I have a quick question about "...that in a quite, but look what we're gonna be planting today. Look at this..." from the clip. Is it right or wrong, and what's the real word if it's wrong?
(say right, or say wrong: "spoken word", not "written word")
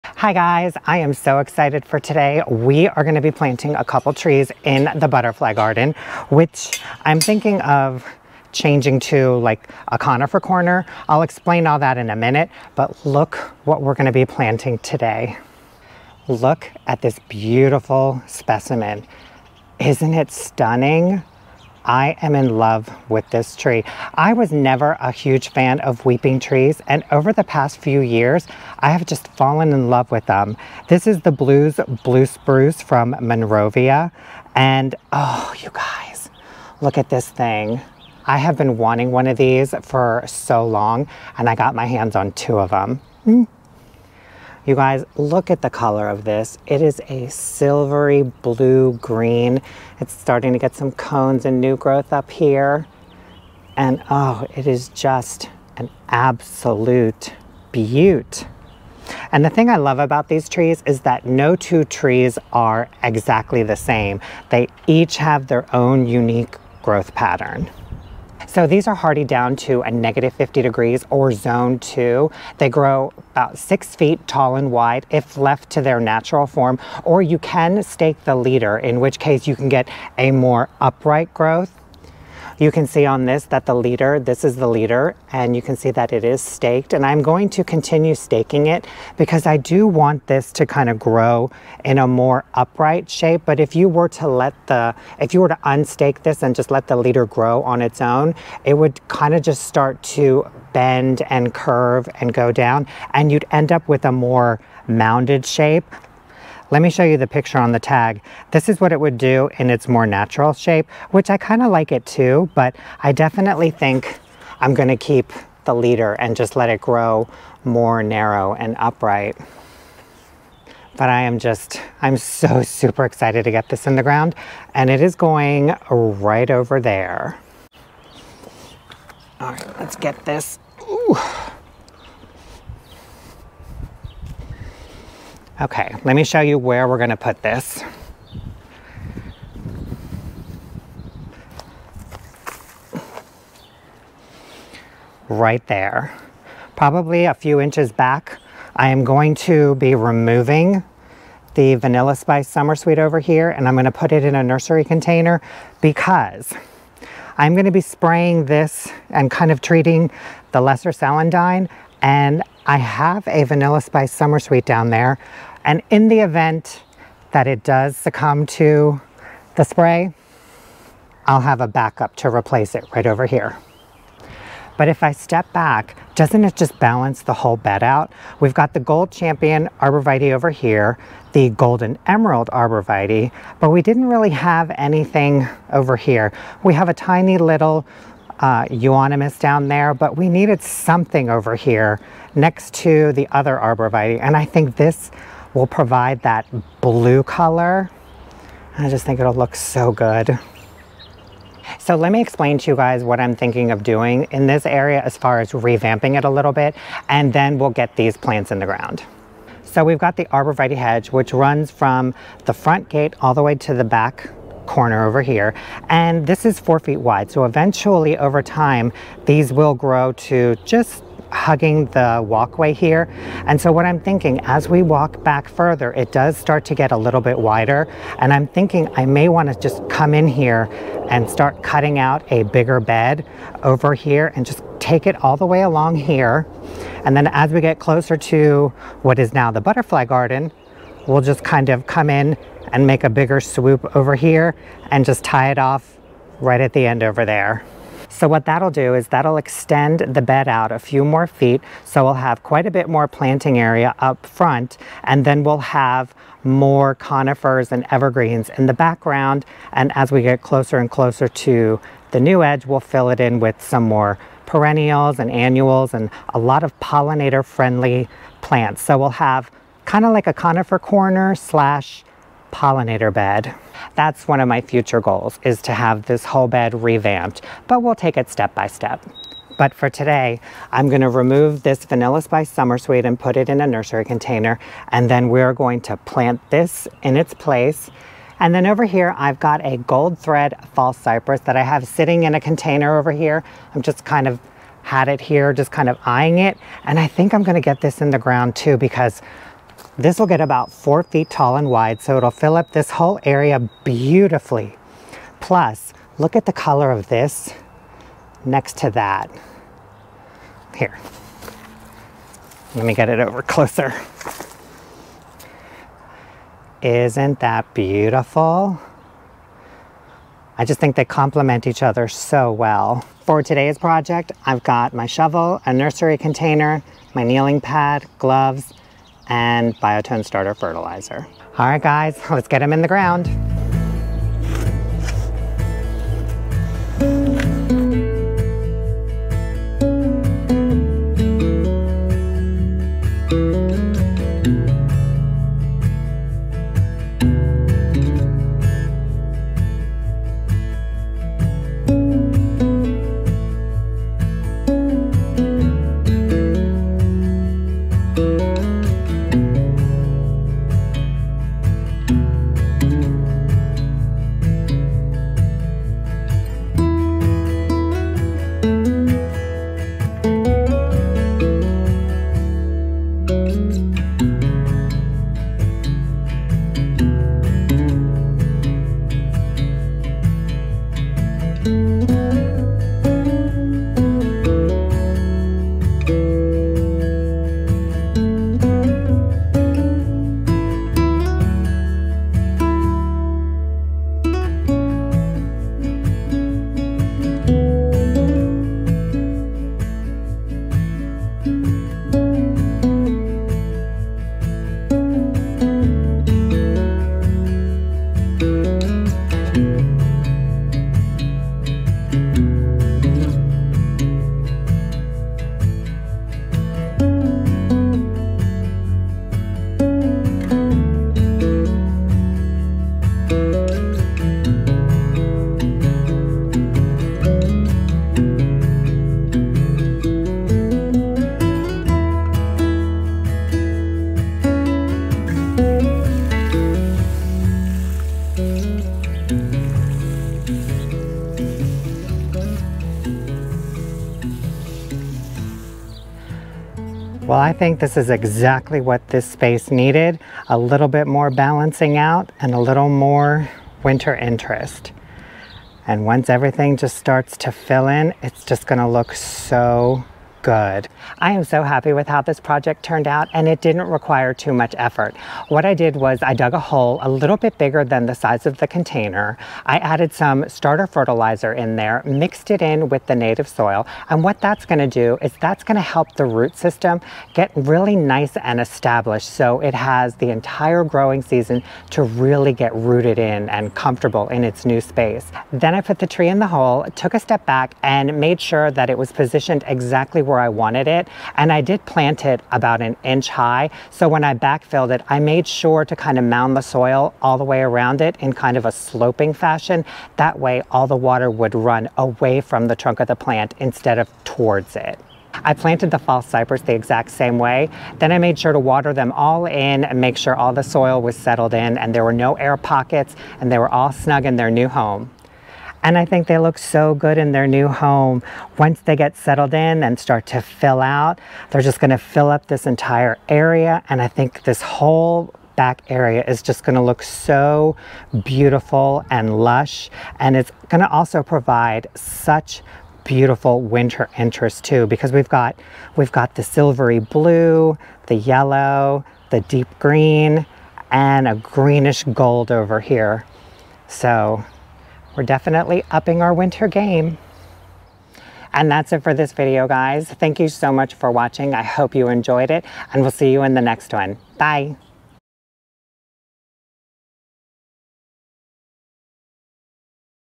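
wrong: "minute", not "quite".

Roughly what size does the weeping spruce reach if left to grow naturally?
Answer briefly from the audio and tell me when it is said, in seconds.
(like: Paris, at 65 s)
6 feet, at 73 s.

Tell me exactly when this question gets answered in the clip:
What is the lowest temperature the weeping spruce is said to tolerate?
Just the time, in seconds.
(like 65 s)
69 s.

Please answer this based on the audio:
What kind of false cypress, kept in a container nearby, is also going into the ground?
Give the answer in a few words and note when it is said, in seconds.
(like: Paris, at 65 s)
Gold Thread, at 289 s.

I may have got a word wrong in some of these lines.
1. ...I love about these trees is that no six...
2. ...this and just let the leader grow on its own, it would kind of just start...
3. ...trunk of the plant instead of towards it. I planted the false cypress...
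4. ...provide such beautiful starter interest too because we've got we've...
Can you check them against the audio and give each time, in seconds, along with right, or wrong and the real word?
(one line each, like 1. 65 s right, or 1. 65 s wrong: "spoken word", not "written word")
1. 59 s wrong: "two", not "six"
2. 96 s right
3. 502 s right
4. 531 s wrong: "winter", not "starter".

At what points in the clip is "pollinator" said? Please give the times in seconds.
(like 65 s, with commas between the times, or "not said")
266 s, 272 s.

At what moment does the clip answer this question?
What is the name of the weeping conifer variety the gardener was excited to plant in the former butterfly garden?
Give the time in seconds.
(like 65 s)
31 s.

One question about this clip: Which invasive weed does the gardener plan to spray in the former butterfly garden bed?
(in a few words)
lesser celandine.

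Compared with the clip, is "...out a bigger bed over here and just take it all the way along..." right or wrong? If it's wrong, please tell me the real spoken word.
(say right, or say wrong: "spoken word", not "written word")
right.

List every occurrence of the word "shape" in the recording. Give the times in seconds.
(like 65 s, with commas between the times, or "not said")
93 s, 105 s, 110 s.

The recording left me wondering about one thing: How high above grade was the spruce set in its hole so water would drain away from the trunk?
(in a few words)
1 inch.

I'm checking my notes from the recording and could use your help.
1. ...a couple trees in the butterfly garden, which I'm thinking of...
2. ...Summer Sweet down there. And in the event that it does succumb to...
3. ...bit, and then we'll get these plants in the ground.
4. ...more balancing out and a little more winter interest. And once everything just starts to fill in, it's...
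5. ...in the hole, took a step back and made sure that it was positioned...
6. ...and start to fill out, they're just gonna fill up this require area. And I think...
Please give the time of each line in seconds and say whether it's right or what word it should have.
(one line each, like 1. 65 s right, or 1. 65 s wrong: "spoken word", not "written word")
1. 3 s right
2. 164 s right
3. 206 s right
4. 451 s right
5. 486 s right
6. 519 s wrong: "entire", not "require".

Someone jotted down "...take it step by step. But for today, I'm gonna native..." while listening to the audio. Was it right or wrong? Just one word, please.
wrong.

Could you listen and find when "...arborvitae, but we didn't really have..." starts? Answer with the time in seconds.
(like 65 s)
182 s.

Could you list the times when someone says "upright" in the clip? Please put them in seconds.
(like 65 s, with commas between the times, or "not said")
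80 s, 92 s, 118 s.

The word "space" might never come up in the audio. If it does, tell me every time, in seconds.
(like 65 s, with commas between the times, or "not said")
449 s, 484 s.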